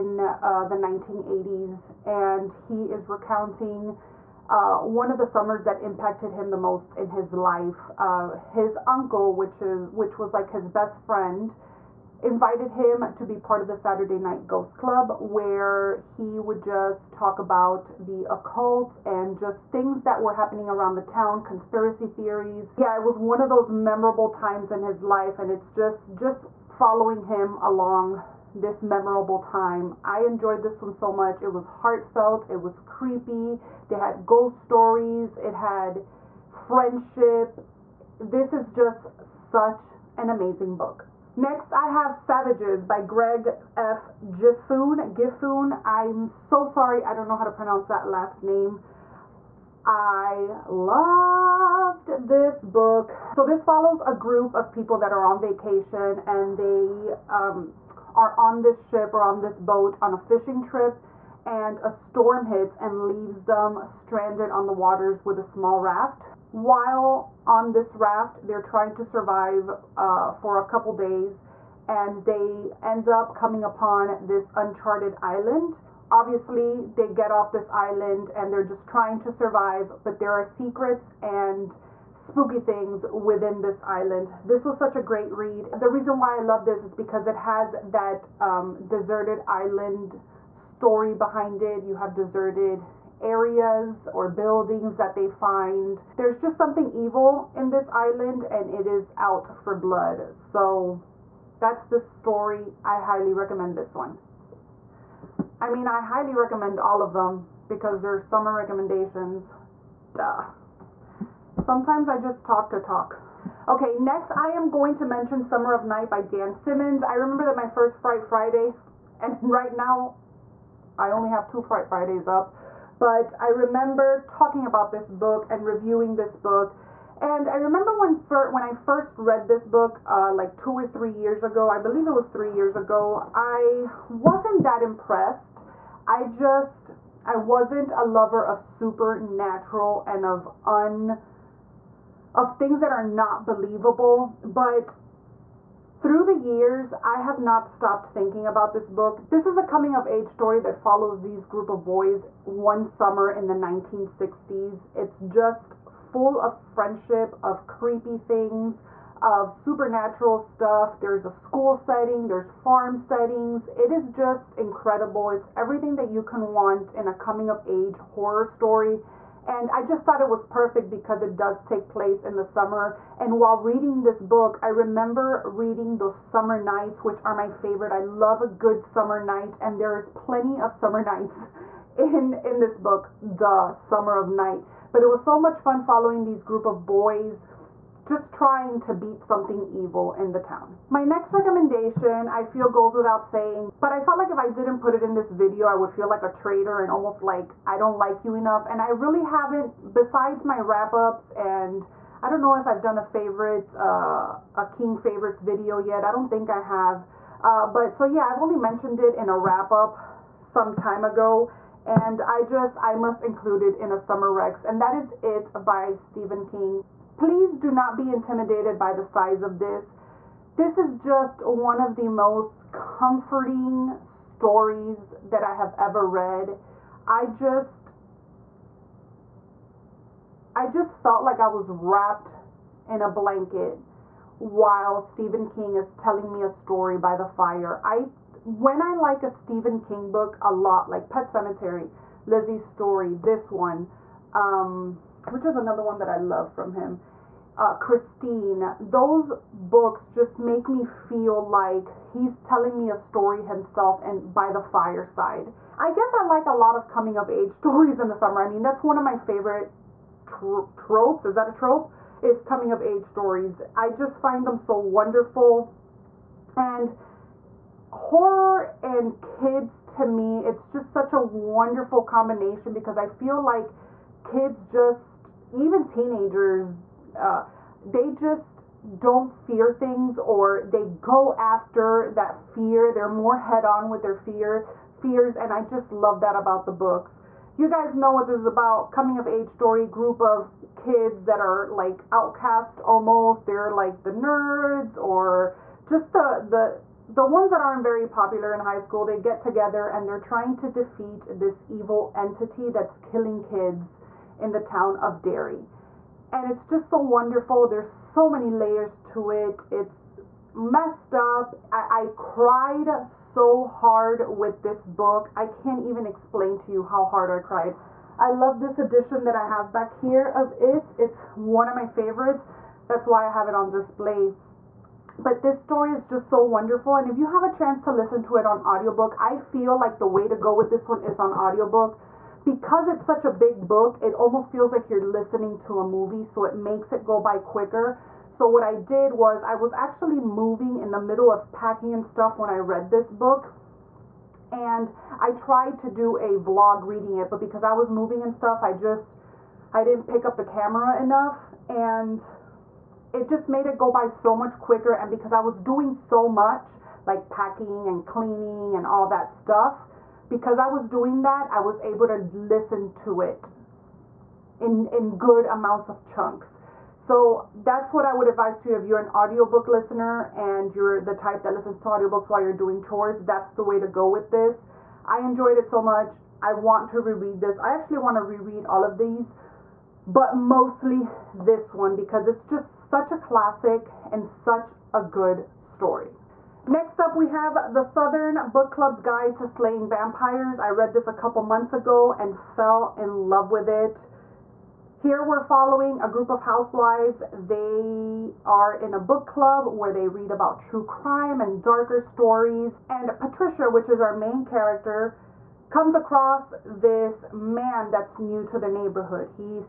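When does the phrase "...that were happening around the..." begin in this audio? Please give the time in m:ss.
0:20.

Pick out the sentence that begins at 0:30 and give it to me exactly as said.
I enjoyed this one so much.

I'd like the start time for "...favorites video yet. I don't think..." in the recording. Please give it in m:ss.
3:24.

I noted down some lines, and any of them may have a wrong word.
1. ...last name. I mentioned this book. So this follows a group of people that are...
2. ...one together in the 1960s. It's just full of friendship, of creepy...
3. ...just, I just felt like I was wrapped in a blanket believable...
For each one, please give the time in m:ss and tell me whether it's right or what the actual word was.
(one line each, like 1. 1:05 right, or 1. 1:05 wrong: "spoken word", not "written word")
1. 0:48 wrong: "loved", not "mentioned"
2. 2:32 wrong: "summer", not "together"
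3. 3:47 wrong: "while", not "believable".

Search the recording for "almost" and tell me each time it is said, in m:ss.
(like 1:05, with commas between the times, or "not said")
3:16, 4:52, 5:34.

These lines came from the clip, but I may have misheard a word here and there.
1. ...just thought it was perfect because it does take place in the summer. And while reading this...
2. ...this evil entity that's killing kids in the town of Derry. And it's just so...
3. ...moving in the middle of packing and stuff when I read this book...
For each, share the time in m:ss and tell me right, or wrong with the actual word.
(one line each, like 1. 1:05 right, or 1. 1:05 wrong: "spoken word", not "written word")
1. 2:49 right
2. 5:01 right
3. 5:40 right.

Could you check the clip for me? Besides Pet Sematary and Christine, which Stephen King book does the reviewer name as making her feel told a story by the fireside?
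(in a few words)
Lisey's Story.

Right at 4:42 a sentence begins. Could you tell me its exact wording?
They're more head on with their fear fears and I just love that about the books.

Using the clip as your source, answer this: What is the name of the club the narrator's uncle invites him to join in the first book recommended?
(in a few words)
Saturday Night Ghost Club.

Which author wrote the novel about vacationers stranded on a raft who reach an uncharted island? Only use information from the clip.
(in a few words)
Greg F. Gifune.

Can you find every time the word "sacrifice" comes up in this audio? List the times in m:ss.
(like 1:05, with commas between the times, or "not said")
not said.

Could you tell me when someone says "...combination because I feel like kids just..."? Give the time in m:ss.
4:32.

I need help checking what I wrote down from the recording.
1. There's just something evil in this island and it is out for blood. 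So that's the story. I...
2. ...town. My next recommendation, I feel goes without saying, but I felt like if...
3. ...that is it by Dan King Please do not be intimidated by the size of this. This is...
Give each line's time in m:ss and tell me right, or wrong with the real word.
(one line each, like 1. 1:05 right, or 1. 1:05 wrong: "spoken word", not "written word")
1. 1:36 right
2. 3:10 right
3. 3:34 wrong: "Stephen", not "Dan".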